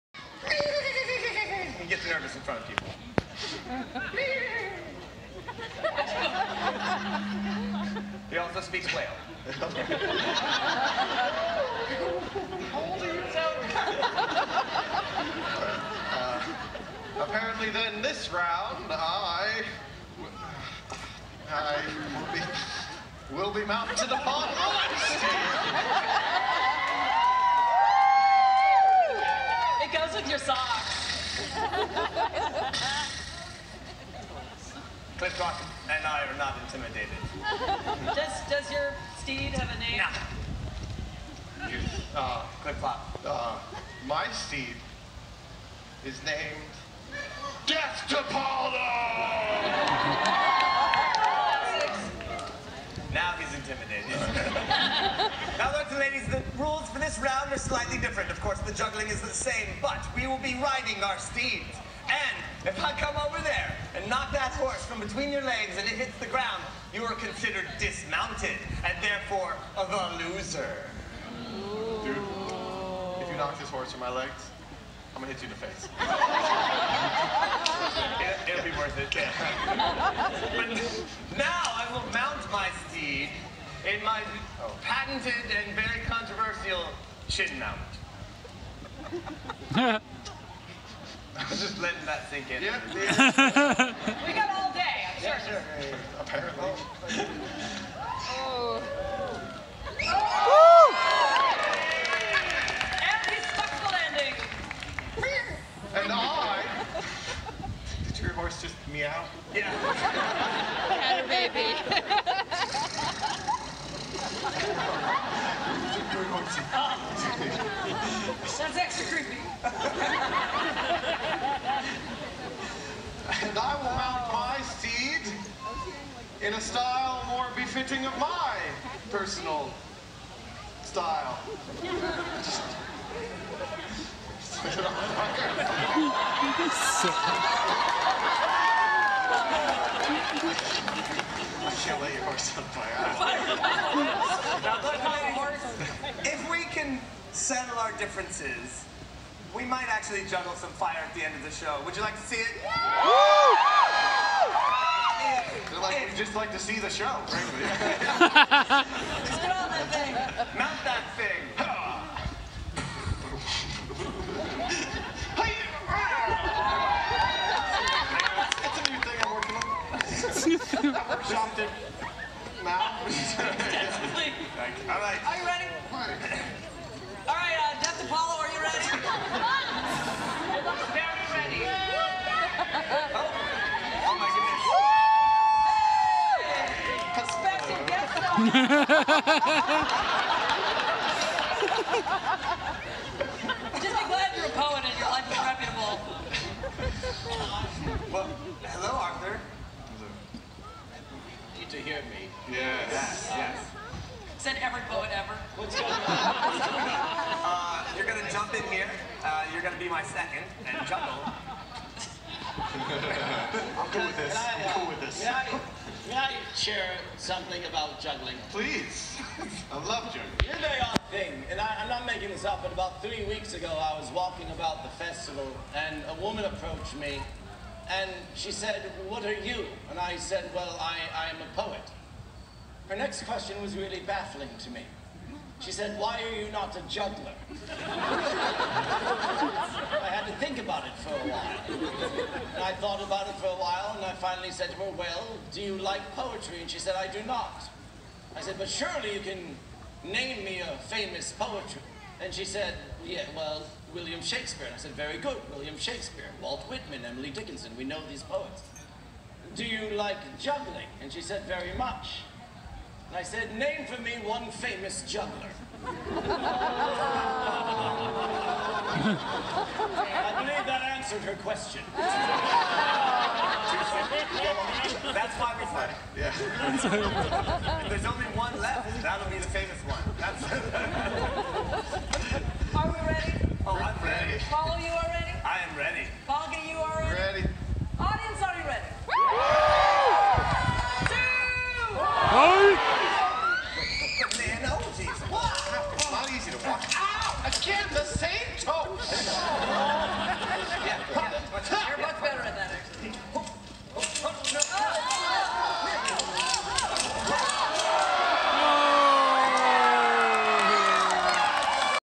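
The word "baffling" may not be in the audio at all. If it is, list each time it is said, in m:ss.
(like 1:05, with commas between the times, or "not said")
3:54.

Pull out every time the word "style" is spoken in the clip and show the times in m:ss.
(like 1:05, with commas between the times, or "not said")
2:06, 2:10.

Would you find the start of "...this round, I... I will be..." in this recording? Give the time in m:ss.
0:18.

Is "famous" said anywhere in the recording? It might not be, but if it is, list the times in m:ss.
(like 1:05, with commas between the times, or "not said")
4:10, 4:24, 4:39.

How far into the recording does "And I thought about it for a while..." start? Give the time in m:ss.
4:02.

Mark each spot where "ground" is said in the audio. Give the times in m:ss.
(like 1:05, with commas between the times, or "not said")
1:06.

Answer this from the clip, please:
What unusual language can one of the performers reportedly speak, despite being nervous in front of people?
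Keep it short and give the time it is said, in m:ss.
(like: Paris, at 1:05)
Whale, at 0:08.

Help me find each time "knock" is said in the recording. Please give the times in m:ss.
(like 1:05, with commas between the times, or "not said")
1:04, 1:13.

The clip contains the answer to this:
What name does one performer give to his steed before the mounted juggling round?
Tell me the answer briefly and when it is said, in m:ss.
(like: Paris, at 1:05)
Death to Paulo, at 0:47.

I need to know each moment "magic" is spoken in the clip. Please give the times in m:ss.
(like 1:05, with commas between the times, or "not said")
not said.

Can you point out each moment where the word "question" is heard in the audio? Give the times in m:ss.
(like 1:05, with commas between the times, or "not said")
3:53, 4:31.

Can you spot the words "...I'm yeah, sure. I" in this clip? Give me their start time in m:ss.
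1:35.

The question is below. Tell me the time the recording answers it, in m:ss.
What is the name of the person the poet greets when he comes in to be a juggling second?
3:18.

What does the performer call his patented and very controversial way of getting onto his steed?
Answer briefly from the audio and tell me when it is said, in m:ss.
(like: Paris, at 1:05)
Chin mount, at 1:27.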